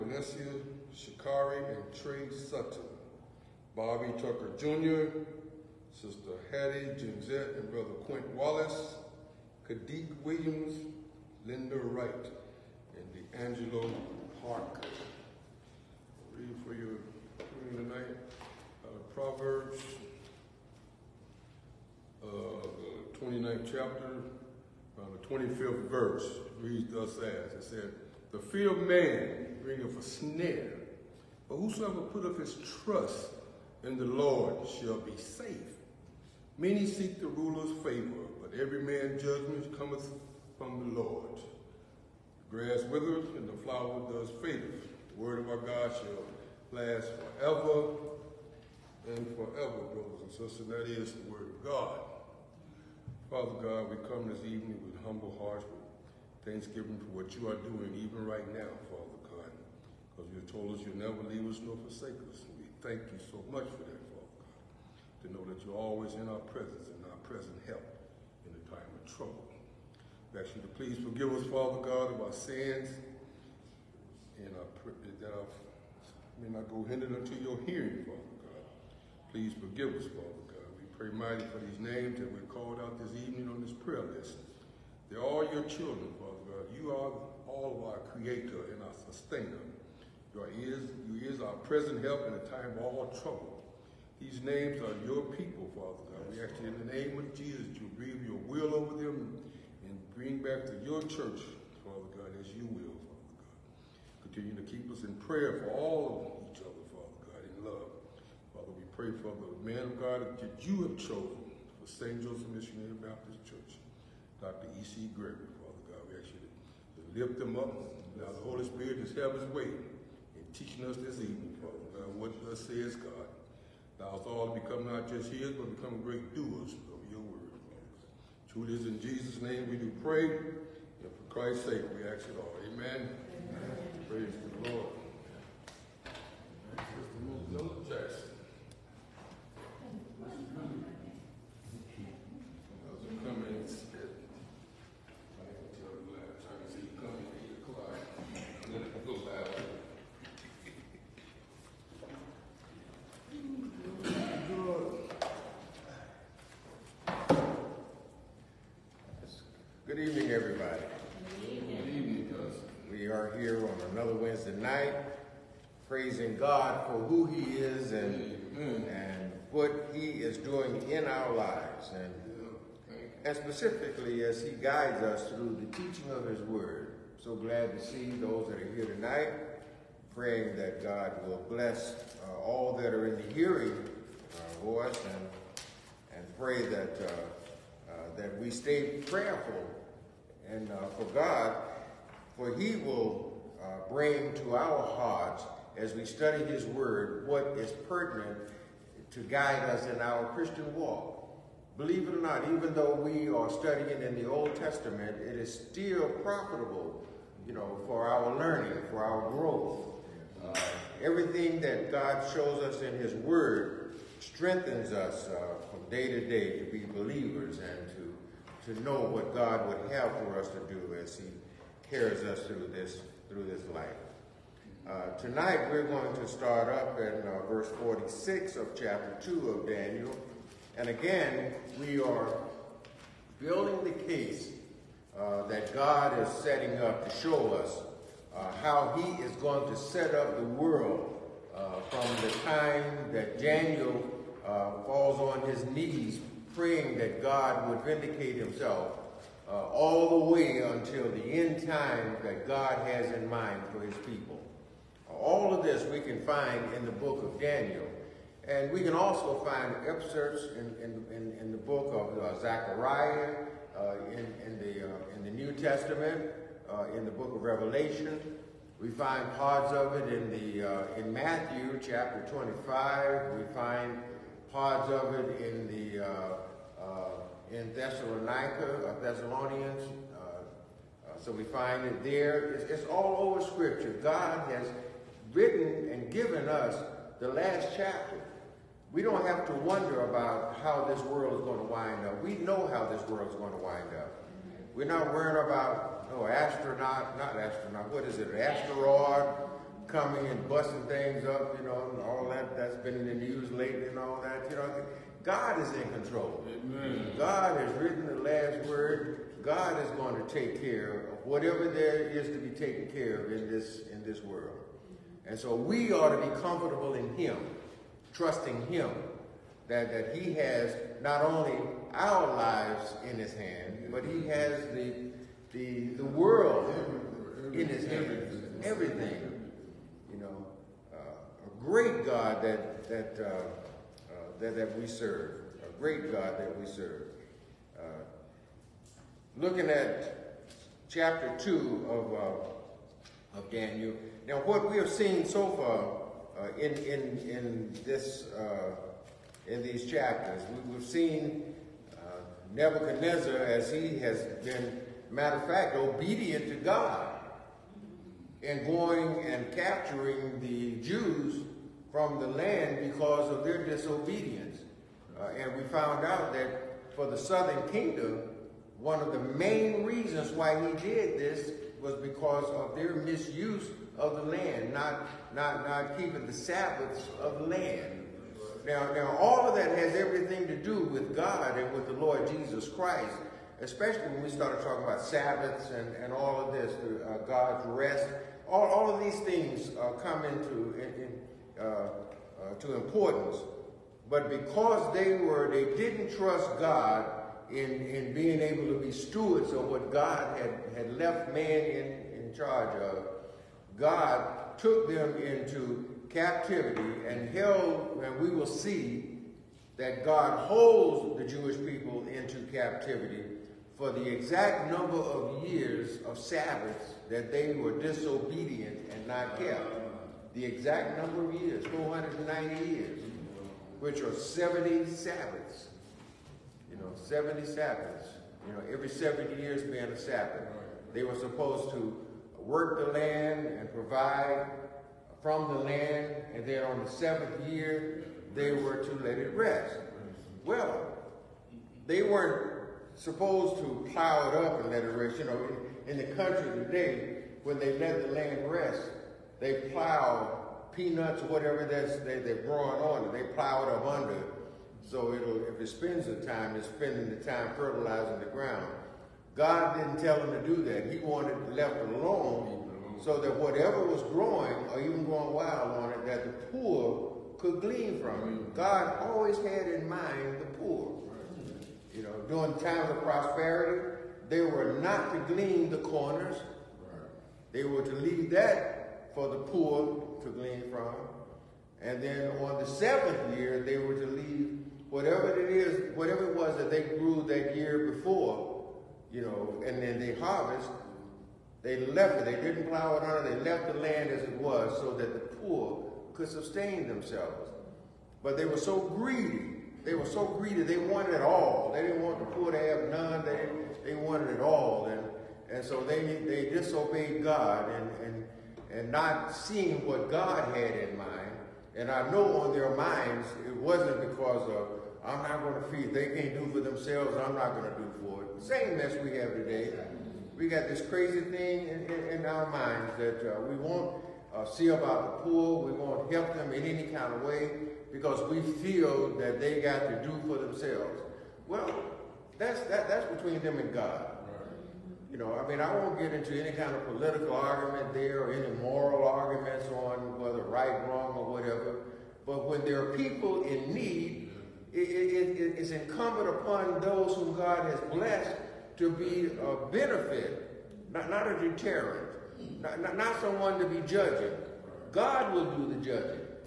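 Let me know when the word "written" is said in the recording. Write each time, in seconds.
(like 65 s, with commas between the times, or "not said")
285 s, 307 s.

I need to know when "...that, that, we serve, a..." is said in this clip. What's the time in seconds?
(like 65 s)
334 s.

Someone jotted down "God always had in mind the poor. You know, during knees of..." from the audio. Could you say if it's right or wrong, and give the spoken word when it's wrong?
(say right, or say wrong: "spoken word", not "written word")
wrong: "times", not "knees".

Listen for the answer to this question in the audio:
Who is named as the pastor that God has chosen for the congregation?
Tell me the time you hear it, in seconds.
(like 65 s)
114 s.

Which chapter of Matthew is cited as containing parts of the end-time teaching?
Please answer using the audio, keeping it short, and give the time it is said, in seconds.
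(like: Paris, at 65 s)
25, at 272 s.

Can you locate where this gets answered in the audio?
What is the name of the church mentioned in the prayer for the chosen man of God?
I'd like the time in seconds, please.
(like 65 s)
111 s.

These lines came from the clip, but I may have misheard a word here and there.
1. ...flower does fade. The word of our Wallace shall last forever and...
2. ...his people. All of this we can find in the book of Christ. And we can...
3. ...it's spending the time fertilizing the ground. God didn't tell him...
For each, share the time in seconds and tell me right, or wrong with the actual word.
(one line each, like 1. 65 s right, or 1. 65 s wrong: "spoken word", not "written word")
1. 43 s wrong: "God", not "Wallace"
2. 253 s wrong: "Daniel", not "Christ"
3. 456 s right.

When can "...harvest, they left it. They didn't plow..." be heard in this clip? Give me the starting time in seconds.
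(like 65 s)
490 s.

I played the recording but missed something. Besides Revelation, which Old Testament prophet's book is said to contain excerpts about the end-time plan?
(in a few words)
Zechariah.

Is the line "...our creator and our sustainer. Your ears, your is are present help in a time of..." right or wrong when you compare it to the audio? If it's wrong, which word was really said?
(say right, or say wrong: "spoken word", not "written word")
right.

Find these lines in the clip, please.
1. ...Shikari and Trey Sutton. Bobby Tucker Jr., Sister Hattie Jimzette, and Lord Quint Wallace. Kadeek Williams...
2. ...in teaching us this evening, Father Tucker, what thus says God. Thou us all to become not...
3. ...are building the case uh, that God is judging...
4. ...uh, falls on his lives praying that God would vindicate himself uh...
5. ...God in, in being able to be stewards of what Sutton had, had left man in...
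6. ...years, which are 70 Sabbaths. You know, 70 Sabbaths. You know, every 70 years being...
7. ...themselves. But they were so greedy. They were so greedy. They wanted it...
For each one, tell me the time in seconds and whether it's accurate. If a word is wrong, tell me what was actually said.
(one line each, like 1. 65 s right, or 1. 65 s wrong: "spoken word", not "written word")
1. 0 s wrong: "Brother", not "Lord"
2. 119 s wrong: "God", not "Tucker"
3. 232 s wrong: "setting", not "judging"
4. 244 s wrong: "knees", not "lives"
5. 396 s wrong: "God", not "Sutton"
6. 422 s right
7. 496 s right.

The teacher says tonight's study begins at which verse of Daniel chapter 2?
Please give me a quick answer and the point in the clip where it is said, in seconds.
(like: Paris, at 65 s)
46, at 227 s.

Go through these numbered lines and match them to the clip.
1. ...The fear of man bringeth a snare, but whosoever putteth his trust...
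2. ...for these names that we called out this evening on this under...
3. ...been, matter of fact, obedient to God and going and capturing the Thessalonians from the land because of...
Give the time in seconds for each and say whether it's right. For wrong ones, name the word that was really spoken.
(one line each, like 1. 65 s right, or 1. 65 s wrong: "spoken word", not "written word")
1. 28 s right
2. 81 s wrong: "prayer", not "under"
3. 354 s wrong: "Jews", not "Thessalonians".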